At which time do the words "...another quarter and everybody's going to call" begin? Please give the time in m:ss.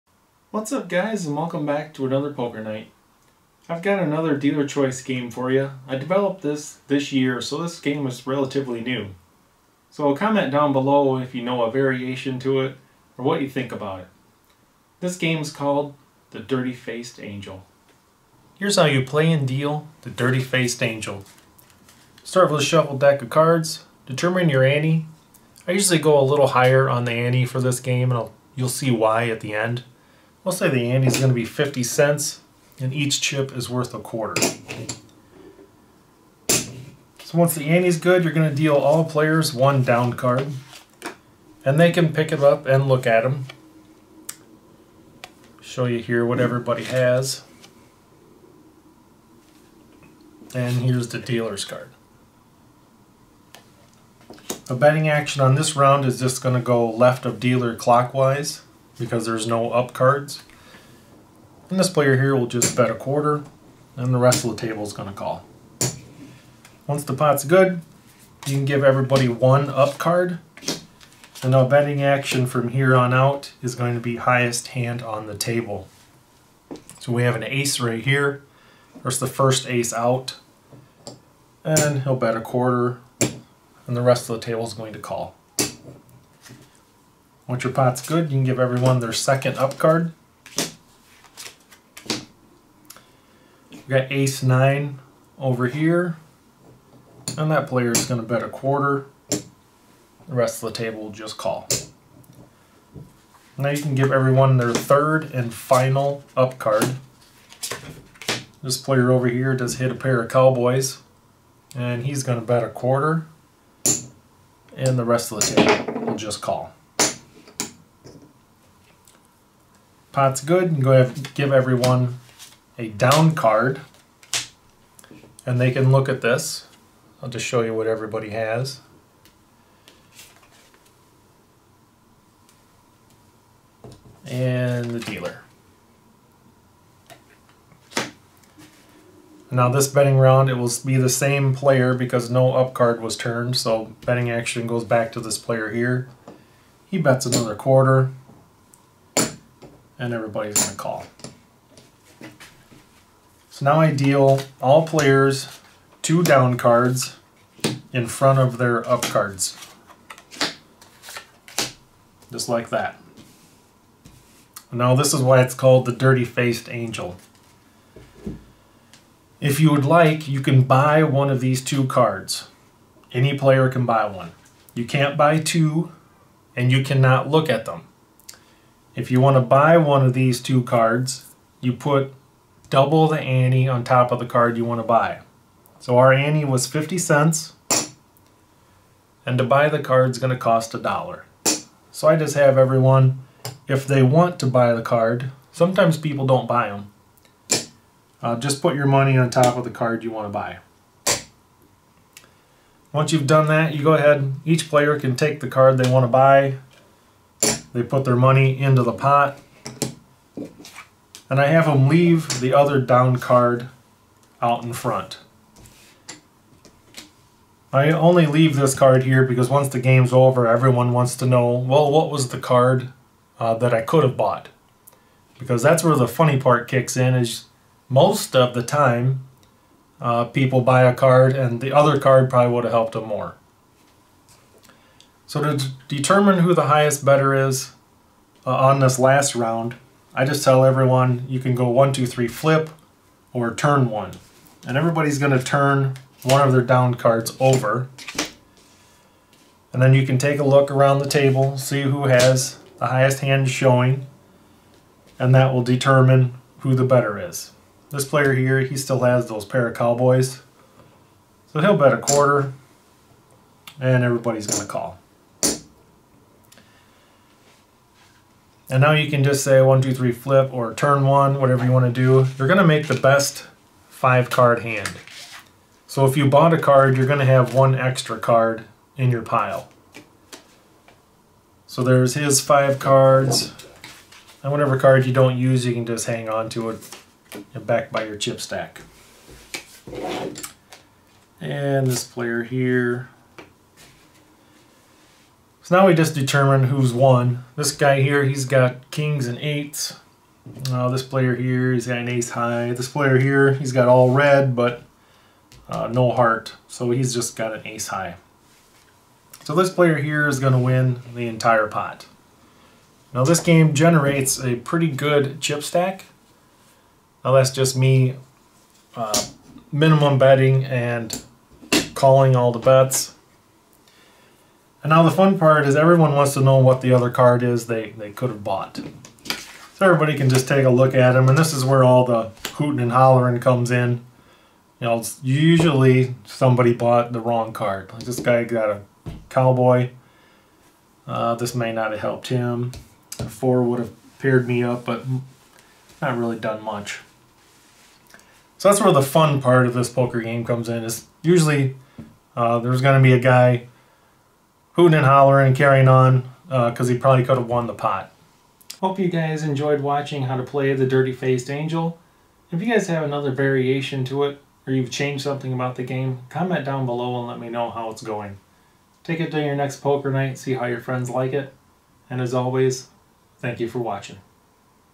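2:27.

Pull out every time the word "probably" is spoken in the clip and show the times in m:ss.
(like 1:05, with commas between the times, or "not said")
3:52, 5:56.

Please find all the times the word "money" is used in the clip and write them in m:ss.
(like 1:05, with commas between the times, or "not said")
3:18, 3:28.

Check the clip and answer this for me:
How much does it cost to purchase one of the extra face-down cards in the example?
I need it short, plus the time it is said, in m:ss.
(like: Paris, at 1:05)
a dollar, at 3:10.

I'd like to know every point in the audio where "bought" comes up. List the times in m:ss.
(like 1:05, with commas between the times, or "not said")
3:44, 4:36, 5:28, 5:36.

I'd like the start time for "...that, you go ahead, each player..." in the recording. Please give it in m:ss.
3:23.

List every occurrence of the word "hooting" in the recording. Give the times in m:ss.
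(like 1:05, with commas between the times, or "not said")
5:32, 5:54.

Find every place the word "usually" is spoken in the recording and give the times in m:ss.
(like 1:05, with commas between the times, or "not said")
0:25, 5:35, 5:51.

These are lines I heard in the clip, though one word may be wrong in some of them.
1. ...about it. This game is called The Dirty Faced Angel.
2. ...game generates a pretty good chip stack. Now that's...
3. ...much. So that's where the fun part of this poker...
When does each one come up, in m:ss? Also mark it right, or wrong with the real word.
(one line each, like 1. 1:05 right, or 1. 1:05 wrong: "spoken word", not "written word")
1. 0:13 right
2. 5:13 right
3. 5:46 right.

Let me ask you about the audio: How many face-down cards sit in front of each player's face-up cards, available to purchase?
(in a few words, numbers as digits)
2.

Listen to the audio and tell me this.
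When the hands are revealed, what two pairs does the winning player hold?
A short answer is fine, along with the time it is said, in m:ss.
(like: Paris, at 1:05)
kings and eights, at 4:58.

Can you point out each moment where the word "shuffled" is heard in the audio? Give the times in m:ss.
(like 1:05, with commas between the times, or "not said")
0:22.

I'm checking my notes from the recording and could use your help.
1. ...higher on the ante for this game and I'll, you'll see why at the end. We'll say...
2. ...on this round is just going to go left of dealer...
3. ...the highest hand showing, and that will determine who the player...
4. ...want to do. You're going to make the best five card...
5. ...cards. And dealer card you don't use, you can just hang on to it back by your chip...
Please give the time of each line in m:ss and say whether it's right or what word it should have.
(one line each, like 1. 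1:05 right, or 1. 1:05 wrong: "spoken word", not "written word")
1. 0:26 right
2. 0:55 right
3. 4:12 wrong: "better", not "player"
4. 4:31 right
5. 4:42 wrong: "whatever", not "dealer".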